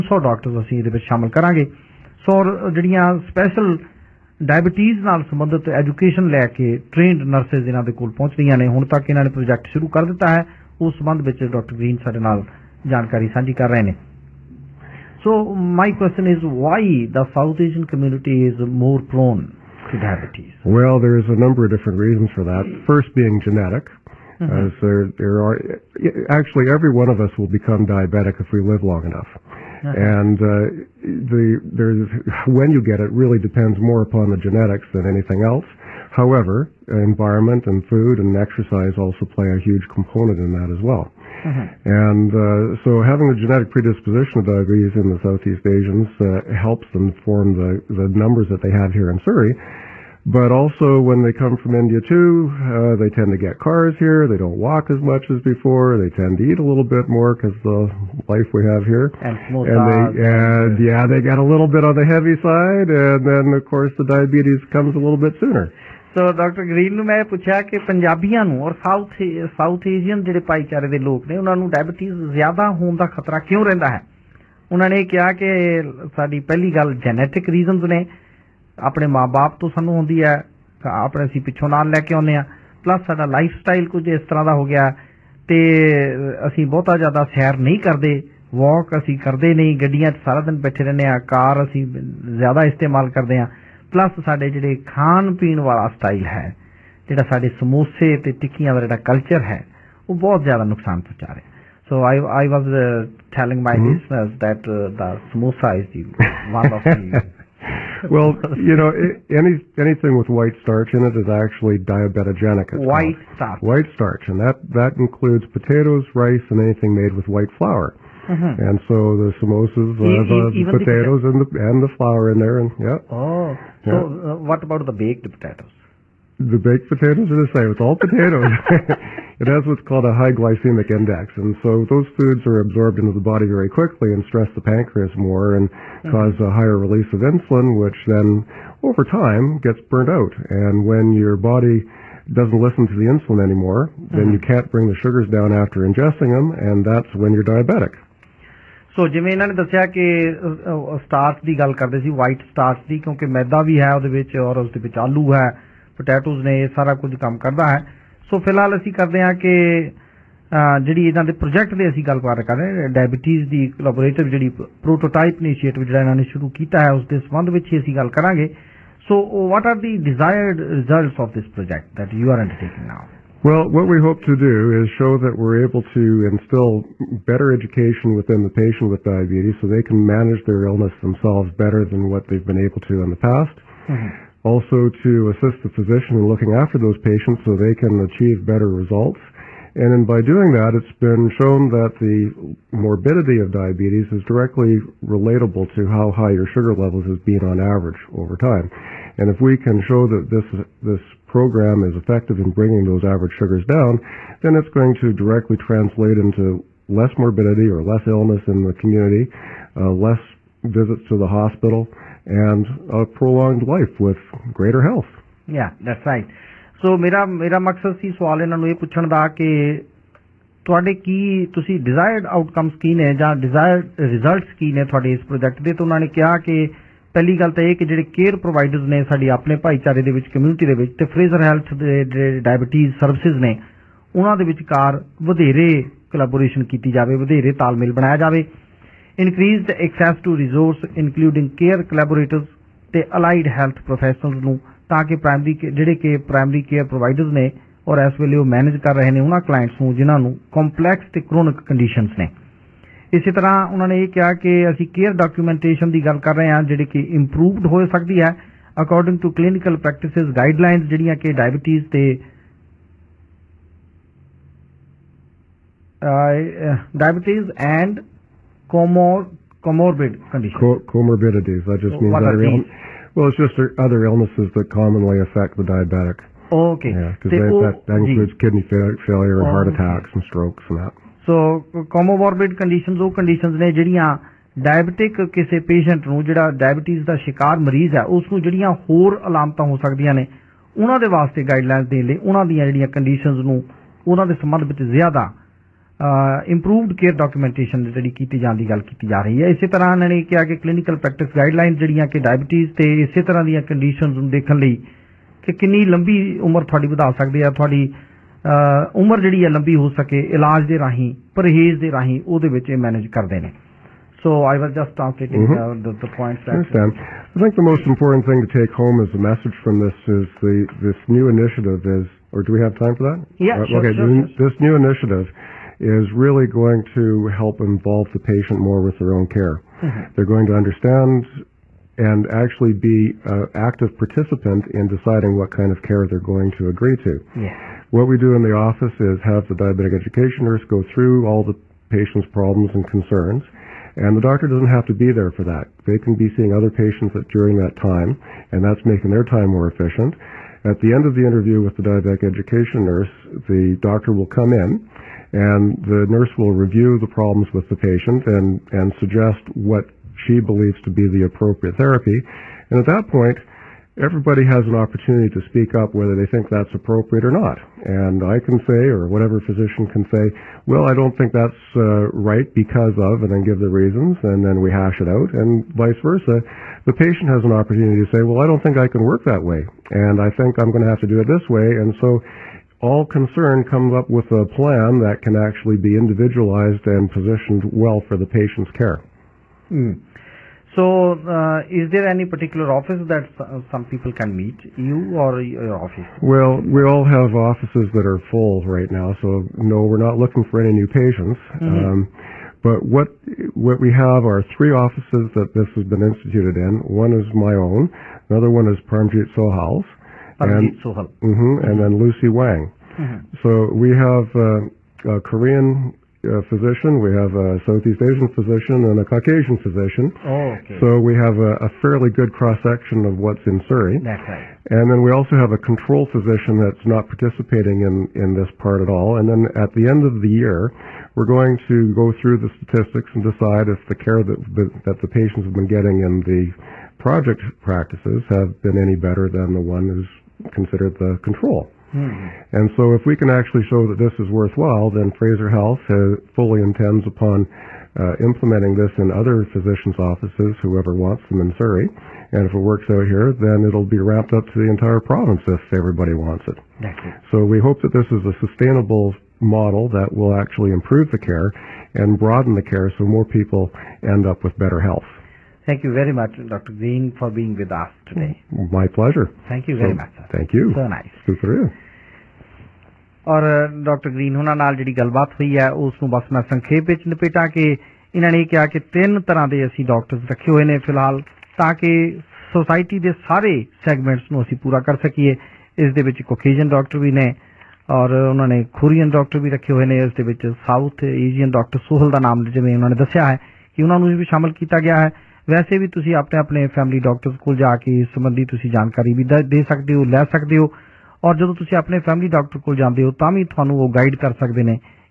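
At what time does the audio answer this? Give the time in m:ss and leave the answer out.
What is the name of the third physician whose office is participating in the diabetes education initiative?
6:51.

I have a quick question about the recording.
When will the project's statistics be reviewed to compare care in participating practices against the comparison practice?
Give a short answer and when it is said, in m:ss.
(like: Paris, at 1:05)
At the end of the year, at 7:09.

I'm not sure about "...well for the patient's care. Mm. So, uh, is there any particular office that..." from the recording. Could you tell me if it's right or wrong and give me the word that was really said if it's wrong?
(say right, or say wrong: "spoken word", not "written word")
right.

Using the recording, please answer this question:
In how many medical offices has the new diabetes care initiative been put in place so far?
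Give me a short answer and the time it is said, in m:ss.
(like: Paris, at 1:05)
3, at 6:44.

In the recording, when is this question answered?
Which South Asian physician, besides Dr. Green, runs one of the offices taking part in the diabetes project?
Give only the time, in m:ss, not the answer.
6:48.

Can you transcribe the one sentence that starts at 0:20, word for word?
Well, there's a number of different reasons for that.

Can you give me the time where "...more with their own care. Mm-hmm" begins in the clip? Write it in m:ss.
5:28.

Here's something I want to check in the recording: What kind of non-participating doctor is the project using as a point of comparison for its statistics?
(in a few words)
Control physician.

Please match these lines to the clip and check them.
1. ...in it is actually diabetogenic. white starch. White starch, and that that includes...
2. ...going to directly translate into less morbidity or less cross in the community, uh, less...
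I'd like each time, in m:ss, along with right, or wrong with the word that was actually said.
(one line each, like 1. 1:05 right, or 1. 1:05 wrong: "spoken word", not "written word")
1. 1:50 right
2. 3:24 wrong: "illness", not "cross".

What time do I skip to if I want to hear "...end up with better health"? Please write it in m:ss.
7:44.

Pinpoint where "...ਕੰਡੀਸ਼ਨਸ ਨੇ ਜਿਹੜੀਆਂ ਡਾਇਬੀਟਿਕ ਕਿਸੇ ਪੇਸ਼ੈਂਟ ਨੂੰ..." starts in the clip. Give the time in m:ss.
4:43.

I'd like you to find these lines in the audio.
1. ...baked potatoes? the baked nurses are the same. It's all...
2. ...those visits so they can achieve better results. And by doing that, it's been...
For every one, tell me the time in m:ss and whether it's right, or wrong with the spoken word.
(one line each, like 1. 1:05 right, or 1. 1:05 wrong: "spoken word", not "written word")
1. 2:04 wrong: "potatoes", not "nurses"
2. 3:06 wrong: "patients", not "visits".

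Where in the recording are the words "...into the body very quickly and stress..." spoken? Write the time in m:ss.
2:12.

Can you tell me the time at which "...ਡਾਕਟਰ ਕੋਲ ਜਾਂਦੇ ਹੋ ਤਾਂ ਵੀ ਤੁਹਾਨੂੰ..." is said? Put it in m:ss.
8:22.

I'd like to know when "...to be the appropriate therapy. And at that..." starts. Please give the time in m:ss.
6:00.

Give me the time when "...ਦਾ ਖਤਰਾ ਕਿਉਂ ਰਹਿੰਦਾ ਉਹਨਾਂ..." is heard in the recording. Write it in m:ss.
1:12.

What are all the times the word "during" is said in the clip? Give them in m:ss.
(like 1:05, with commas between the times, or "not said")
5:47.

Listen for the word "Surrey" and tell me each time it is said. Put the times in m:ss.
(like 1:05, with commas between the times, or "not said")
0:49, 7:03, 7:31.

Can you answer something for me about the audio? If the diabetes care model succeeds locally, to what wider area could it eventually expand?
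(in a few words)
The entire province.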